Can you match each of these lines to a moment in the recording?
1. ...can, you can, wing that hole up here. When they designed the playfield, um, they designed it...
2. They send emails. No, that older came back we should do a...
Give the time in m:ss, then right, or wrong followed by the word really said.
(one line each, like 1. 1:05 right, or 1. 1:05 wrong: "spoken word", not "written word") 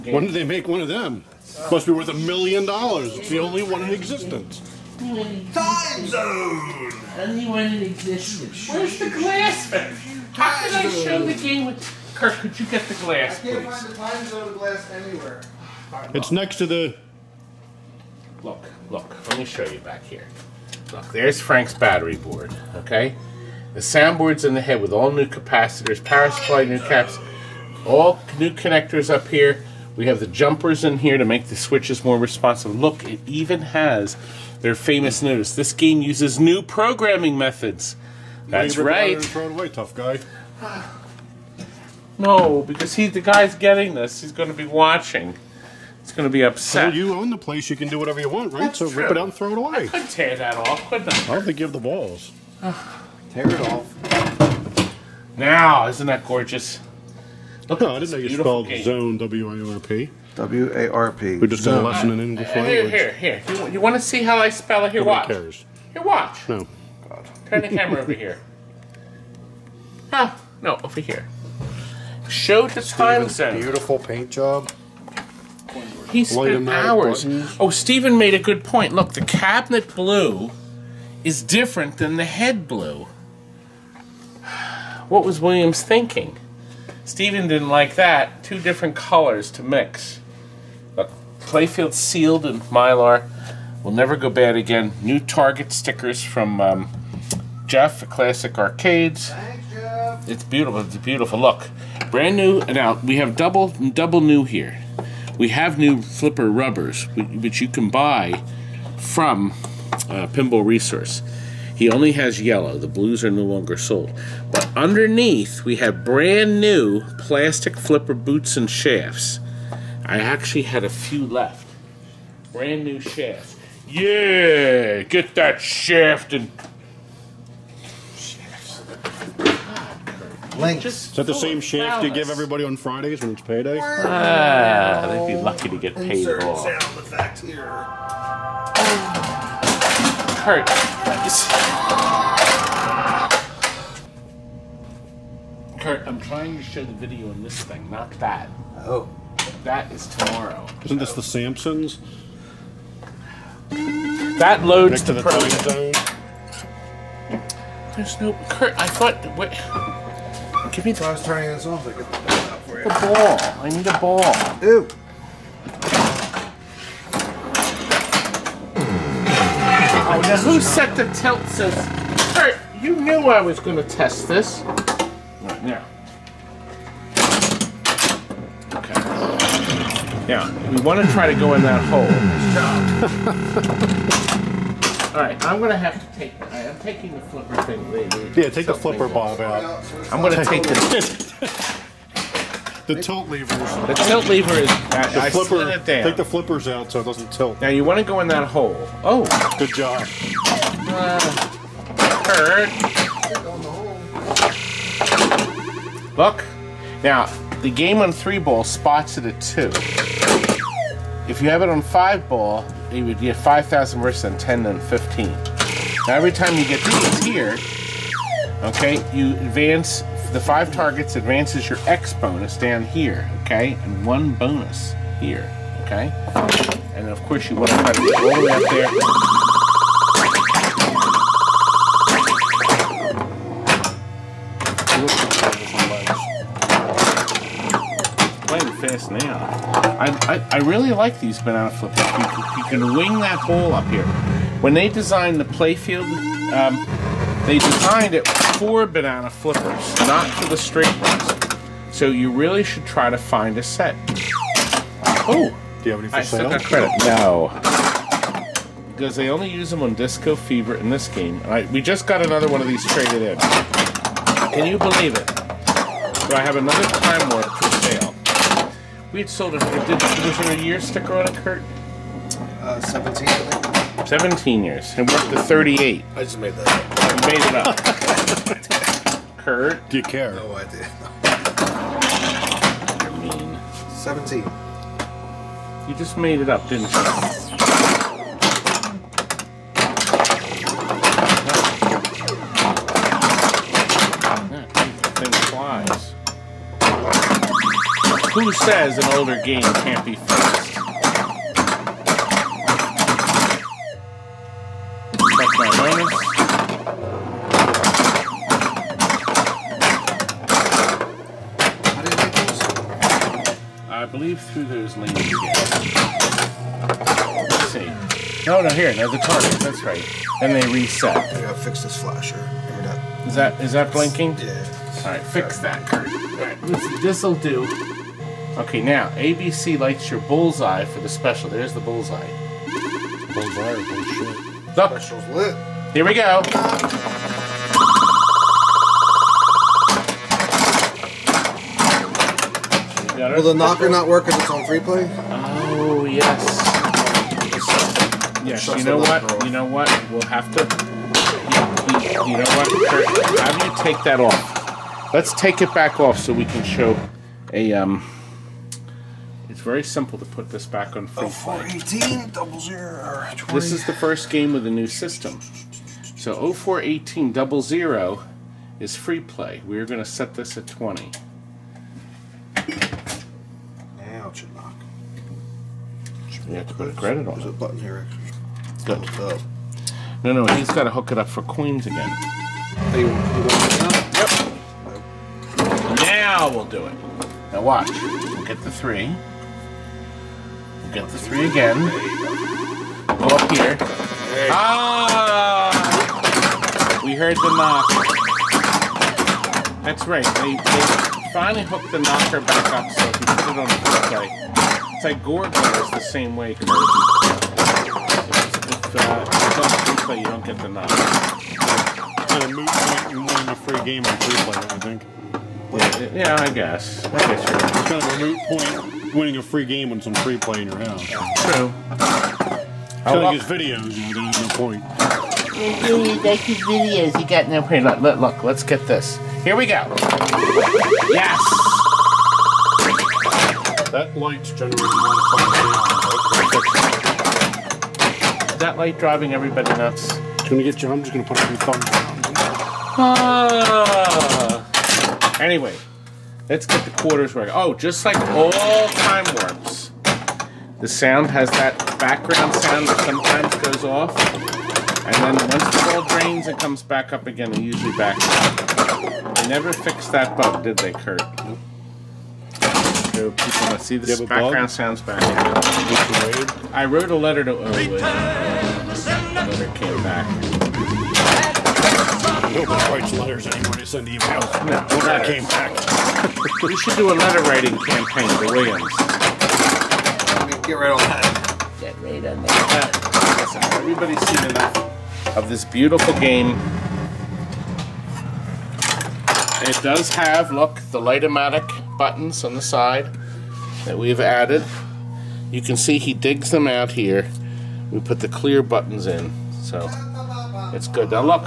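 1. 4:02 right
2. 7:53 wrong: "letter", not "older".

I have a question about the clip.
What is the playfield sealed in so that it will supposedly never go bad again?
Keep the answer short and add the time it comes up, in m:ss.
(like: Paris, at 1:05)
Mylar, at 1:32.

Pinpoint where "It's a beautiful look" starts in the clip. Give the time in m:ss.
1:40.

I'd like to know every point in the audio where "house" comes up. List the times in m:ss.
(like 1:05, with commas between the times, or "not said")
7:00.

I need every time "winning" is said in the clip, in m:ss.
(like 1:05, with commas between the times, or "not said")
6:53, 6:59.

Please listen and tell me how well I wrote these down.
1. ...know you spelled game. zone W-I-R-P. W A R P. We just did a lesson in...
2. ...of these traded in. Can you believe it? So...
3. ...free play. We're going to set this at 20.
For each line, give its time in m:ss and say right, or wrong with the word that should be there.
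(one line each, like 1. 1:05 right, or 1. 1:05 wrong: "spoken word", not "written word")
1. 0:58 right
2. 4:22 right
3. 6:08 right.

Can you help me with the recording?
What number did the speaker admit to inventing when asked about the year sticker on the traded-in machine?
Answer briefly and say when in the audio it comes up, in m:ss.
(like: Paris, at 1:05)
38, at 4:35.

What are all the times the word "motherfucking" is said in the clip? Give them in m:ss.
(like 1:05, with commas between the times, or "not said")
not said.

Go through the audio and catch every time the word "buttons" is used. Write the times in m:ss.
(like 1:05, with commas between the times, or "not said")
1:17, 6:17, 8:11, 8:18.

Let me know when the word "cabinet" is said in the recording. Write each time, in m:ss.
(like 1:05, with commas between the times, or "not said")
1:19.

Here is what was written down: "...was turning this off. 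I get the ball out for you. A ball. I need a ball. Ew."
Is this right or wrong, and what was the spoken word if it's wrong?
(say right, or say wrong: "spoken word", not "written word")
right.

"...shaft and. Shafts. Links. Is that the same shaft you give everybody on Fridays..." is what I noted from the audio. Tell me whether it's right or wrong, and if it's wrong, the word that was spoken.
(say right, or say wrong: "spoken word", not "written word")
right.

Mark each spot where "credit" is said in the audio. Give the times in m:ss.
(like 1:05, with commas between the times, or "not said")
4:16, 6:16.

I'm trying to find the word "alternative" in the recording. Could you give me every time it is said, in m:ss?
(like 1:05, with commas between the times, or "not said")
not said.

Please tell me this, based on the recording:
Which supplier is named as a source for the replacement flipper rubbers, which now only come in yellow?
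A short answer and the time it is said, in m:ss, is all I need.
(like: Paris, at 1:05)
Pinball Resource, at 1:50.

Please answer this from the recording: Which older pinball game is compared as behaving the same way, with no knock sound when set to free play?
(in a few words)
Gorgar.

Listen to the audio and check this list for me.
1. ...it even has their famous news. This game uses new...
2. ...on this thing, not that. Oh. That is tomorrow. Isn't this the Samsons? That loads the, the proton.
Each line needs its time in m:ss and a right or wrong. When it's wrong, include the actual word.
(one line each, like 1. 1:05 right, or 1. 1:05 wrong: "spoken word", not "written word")
1. 0:33 right
2. 2:27 right.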